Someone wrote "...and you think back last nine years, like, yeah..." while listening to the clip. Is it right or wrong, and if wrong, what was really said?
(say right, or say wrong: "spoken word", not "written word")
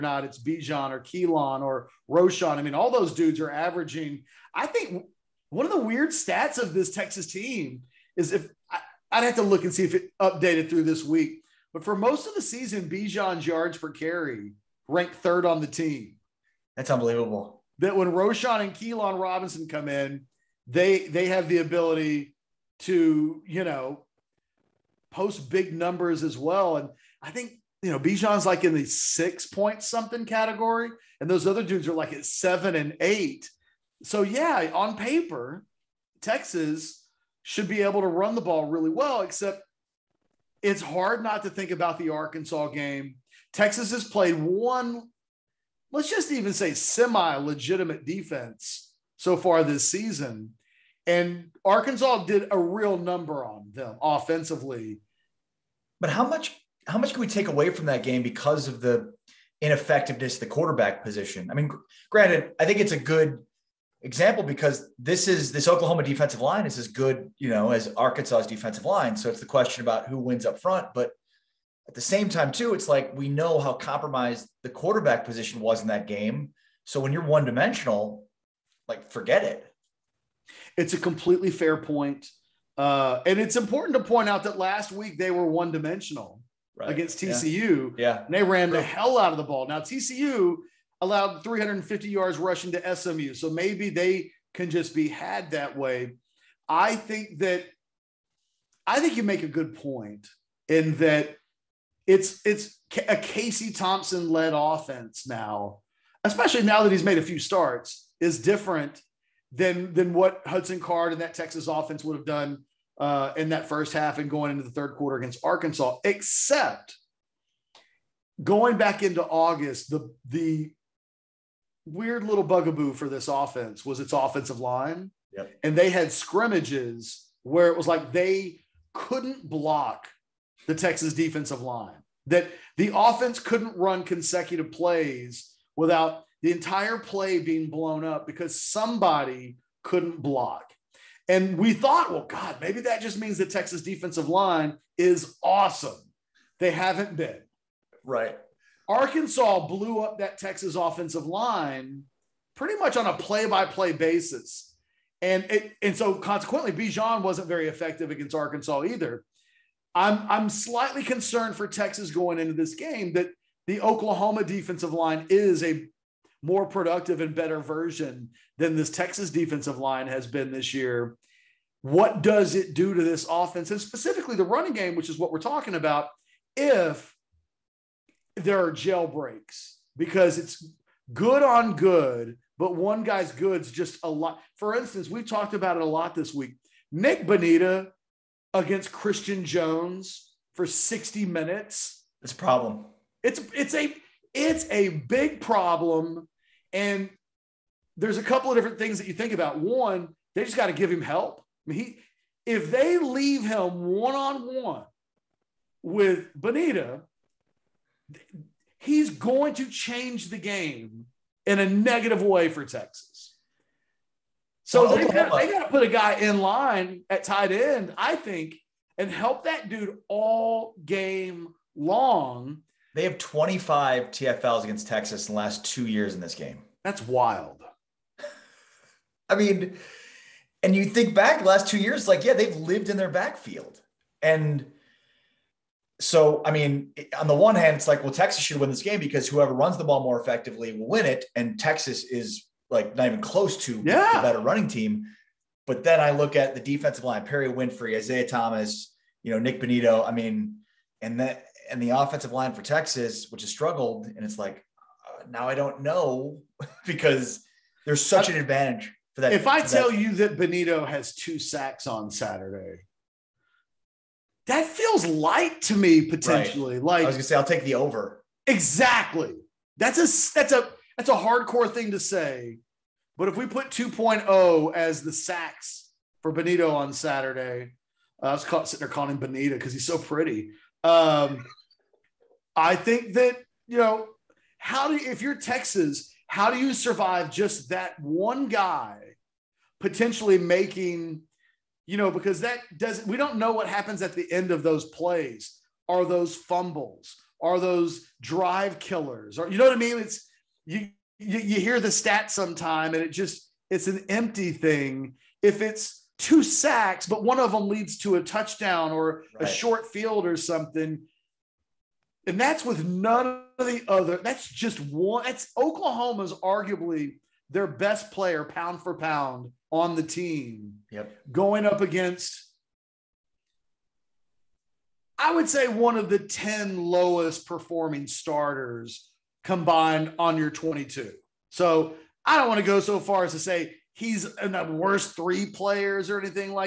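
wrong: "two", not "nine".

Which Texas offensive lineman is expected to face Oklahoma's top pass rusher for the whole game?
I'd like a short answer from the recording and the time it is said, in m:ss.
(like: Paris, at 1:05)
Christian Jones, at 3:08.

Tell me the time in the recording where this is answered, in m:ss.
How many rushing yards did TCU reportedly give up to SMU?
1:31.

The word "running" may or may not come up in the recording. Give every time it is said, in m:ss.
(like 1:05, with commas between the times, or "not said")
2:54, 4:04.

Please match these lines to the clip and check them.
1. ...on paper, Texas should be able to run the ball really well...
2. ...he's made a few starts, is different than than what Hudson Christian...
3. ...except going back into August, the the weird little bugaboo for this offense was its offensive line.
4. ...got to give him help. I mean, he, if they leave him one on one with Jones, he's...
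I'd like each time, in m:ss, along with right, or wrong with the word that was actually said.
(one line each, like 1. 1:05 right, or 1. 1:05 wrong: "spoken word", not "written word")
1. 0:34 right
2. 1:46 wrong: "Card", not "Christian"
3. 1:56 right
4. 3:20 wrong: "Benita", not "Jones".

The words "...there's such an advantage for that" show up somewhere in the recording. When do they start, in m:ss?
4:17.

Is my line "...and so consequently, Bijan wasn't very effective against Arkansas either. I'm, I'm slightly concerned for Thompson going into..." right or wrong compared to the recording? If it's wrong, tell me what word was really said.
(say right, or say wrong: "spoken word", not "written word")
wrong: "Texas", not "Thompson".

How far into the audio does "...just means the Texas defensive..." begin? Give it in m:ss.
2:23.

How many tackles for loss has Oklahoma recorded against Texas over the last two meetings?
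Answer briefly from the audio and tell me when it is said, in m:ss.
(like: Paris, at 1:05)
25, at 3:43.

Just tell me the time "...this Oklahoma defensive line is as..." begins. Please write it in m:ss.
1:05.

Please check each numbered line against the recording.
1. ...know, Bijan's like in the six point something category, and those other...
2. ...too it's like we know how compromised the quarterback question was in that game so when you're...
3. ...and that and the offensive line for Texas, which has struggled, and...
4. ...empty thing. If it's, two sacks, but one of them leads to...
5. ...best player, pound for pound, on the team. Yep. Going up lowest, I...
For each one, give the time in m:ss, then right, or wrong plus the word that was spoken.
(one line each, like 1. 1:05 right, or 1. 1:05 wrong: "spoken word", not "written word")
1. 0:27 right
2. 1:12 wrong: "position", not "question"
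3. 4:11 right
4. 5:04 right
5. 5:17 wrong: "against", not "lowest".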